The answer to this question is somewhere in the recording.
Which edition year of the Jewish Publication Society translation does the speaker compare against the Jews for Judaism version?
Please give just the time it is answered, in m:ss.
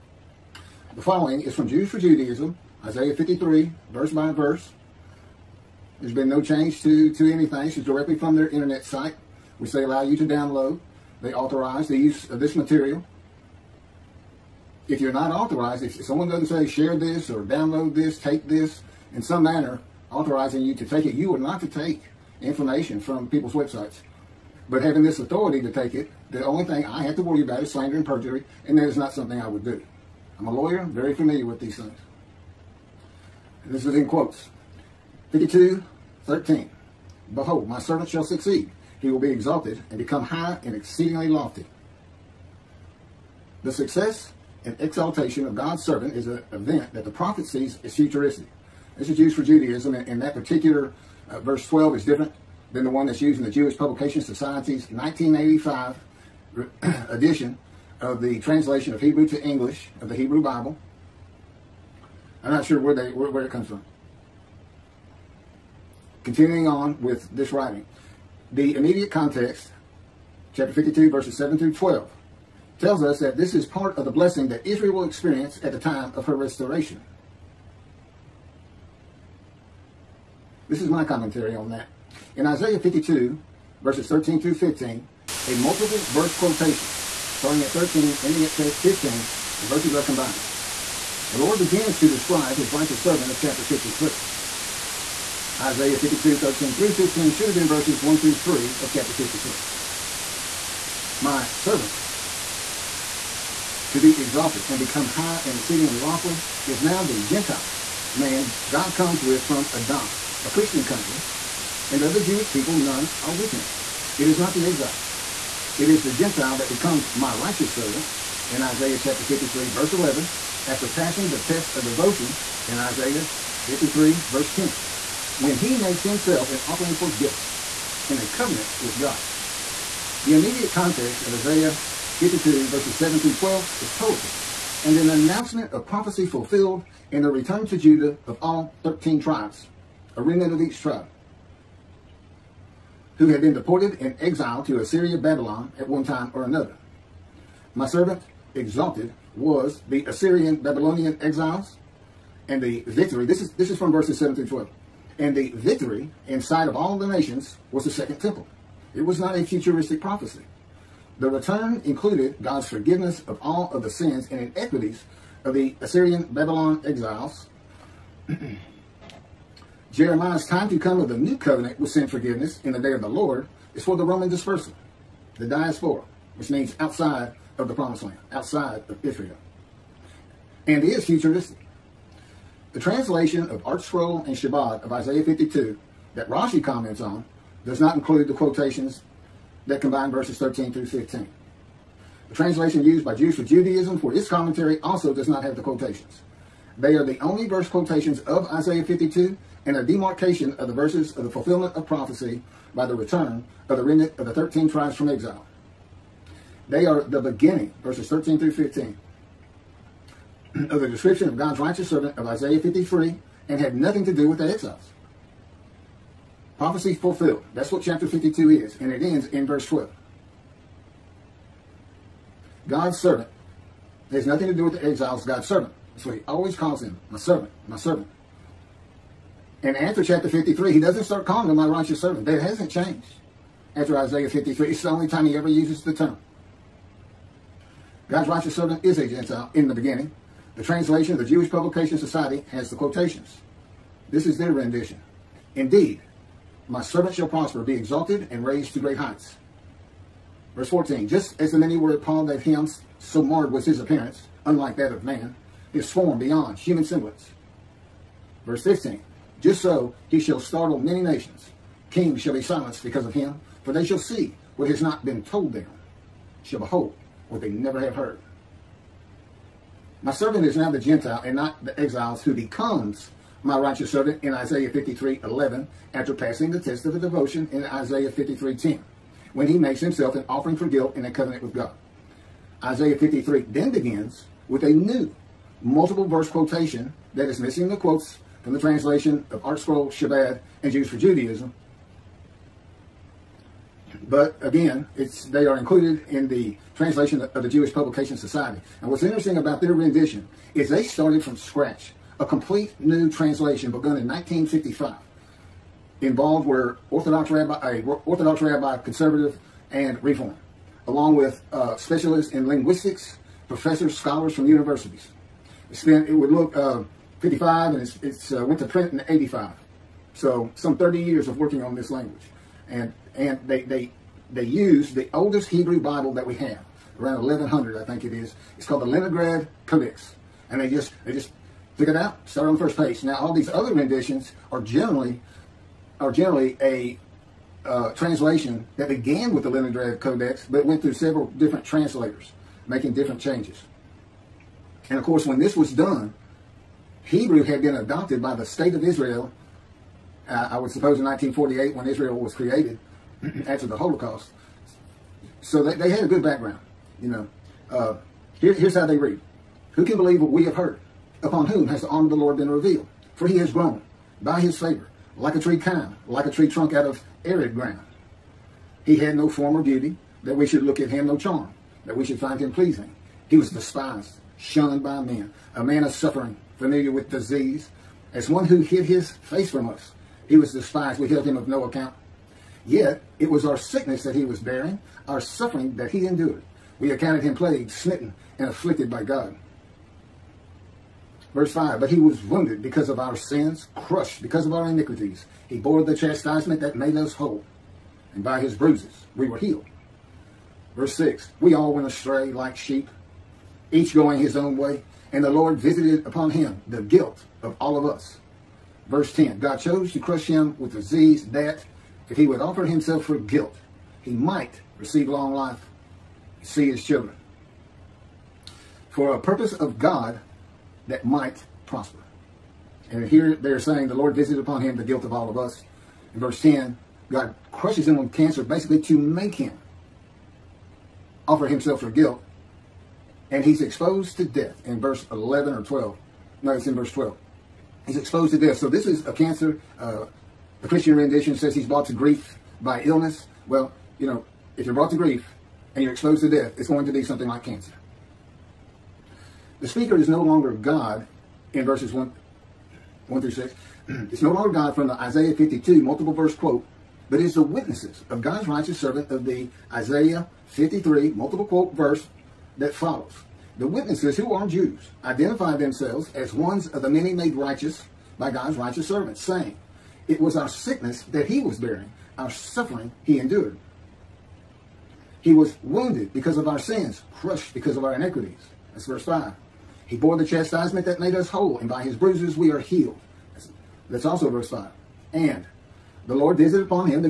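0:54.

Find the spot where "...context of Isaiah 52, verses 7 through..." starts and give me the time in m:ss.
2:10.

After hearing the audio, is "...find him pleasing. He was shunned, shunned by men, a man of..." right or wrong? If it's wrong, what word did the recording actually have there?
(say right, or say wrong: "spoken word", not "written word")
wrong: "despised", not "shunned".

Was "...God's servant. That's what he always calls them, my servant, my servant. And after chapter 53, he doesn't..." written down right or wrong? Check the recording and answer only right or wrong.
right.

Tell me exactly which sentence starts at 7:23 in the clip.
Well, you know, if you're brought to grief, and you're exposed to death, it's going to be something like cancer.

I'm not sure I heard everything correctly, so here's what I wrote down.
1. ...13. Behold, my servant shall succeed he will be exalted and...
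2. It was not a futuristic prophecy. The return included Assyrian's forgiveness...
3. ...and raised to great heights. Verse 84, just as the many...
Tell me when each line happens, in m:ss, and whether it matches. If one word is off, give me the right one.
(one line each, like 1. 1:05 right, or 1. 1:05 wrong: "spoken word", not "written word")
1. 0:36 right
2. 2:38 wrong: "God", not "Assyrian"
3. 4:08 wrong: "14", not "84".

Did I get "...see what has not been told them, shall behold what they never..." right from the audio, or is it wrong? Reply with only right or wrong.
right.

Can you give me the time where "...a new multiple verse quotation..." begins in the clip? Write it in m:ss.
4:44.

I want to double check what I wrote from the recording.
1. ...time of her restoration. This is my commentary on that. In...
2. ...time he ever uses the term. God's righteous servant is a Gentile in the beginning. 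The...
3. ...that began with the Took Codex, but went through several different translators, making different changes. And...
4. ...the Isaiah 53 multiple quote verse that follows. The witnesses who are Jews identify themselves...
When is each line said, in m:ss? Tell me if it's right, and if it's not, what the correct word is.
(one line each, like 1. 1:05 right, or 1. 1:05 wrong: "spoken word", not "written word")
1. 1:15 right
2. 3:55 right
3. 5:38 wrong: "Leningrad", not "Took"
4. 7:39 right.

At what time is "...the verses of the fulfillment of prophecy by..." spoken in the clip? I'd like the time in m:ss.
3:20.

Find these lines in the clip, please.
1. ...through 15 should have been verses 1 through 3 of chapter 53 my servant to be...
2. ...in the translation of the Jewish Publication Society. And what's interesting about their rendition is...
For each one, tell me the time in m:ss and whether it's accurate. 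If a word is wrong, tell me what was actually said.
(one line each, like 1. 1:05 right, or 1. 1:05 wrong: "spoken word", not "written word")
1. 1:36 right
2. 4:56 right.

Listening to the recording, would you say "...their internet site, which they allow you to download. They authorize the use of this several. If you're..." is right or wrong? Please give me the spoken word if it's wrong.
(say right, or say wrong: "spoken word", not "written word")
wrong: "material", not "several".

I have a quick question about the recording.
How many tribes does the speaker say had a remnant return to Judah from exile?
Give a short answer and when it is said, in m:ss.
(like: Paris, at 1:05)
13, at 2:18.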